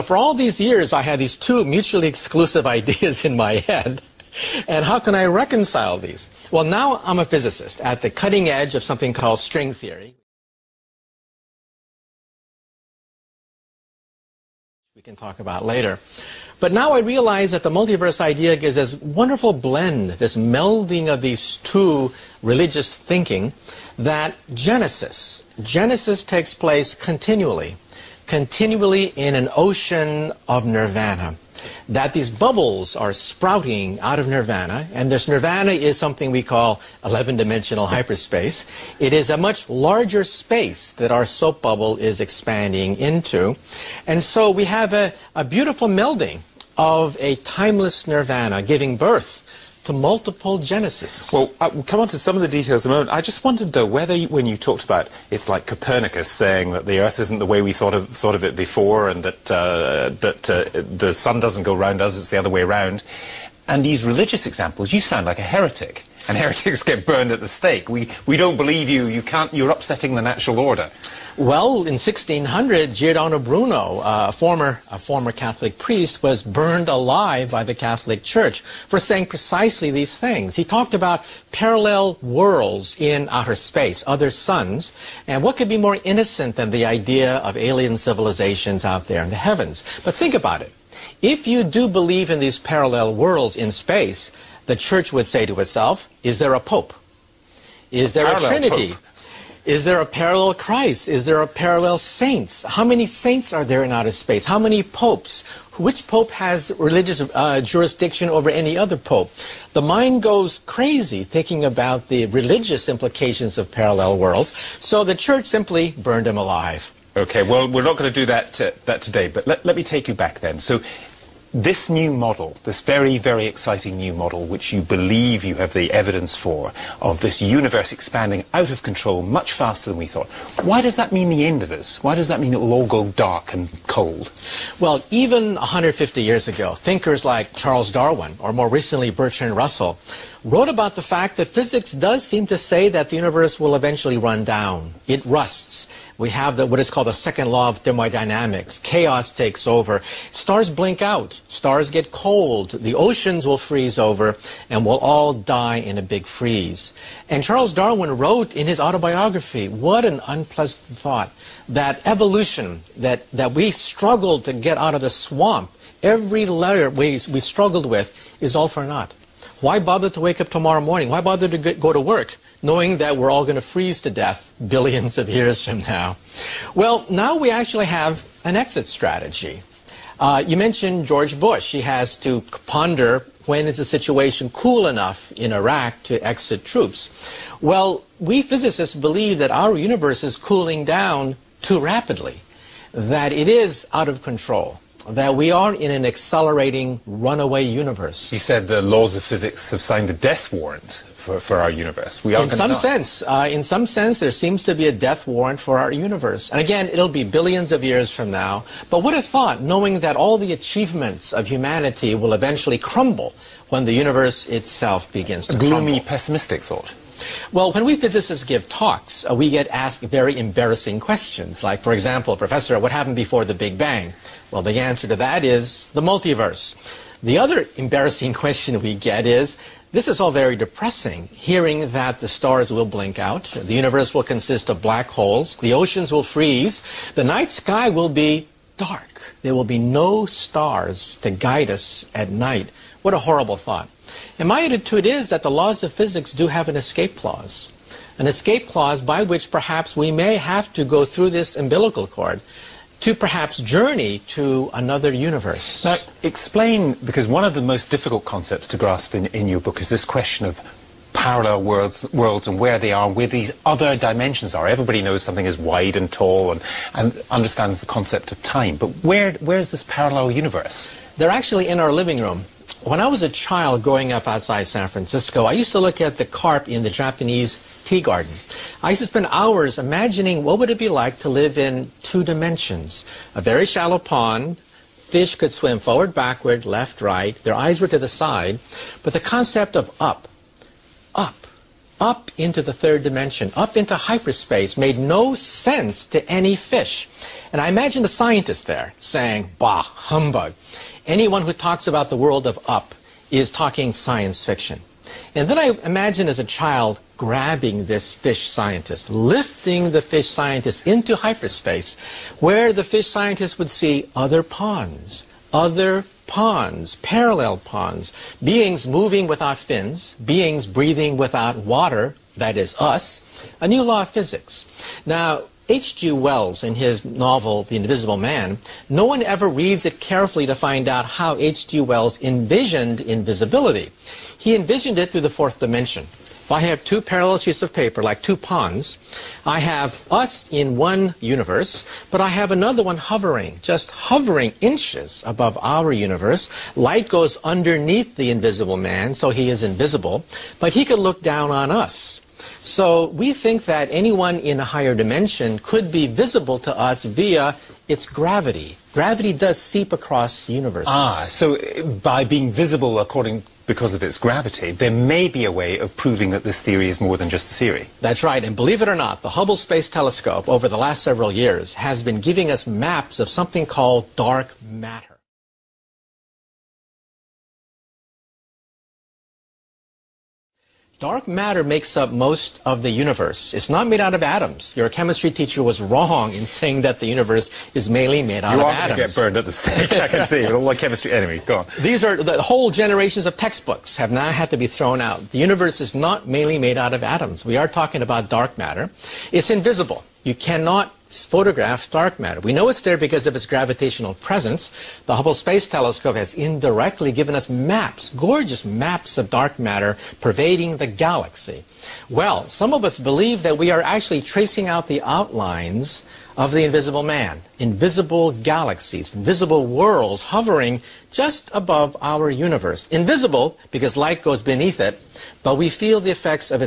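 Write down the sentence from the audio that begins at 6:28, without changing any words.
You get burned at the stake, I can see, with all the chemistry enemy.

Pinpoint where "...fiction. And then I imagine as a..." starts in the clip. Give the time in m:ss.
5:04.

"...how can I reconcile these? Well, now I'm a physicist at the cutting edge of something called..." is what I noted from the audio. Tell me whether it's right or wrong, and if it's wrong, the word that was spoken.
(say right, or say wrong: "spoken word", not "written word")
right.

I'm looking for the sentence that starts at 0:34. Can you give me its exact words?
And this nirvana is something we call 11 dimensional hyperspace.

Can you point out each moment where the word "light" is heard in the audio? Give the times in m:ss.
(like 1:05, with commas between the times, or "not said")
5:46, 7:03.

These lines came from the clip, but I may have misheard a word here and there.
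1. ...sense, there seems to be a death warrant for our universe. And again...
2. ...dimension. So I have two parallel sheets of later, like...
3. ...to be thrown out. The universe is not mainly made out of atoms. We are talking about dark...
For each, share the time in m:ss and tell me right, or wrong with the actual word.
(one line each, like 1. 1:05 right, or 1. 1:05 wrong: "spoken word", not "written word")
1. 3:23 right
2. 5:35 wrong: "paper", not "later"
3. 6:34 right.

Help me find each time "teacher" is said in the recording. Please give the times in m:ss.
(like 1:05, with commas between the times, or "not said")
6:25.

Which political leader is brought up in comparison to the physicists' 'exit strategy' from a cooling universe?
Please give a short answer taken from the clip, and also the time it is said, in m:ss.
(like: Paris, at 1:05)
George Bush, at 3:01.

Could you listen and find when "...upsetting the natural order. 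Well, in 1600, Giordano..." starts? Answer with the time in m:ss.
1:09.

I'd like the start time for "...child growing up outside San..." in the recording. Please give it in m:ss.
4:33.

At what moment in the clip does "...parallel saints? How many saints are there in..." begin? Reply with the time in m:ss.
1:41.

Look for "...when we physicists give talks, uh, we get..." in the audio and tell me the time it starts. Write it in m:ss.
3:37.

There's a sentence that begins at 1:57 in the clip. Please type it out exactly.
Okay, well, we're not going to do that, uh, that today, but let, let me take you back then.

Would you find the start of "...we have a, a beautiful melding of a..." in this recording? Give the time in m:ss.
0:44.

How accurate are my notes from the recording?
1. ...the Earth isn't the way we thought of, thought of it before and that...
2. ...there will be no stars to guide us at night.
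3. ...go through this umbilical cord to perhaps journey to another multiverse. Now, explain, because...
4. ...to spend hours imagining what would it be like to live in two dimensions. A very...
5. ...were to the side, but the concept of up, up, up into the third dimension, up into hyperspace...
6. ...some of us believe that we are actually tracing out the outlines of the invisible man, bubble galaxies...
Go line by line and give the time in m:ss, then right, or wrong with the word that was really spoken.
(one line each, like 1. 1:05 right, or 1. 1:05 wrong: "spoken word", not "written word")
1. 0:56 right
2. 3:59 right
3. 4:10 wrong: "universe", not "multiverse"
4. 4:39 right
5. 4:47 right
6. 6:52 wrong: "invisible", not "bubble".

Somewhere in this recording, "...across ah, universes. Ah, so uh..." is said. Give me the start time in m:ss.
5:59.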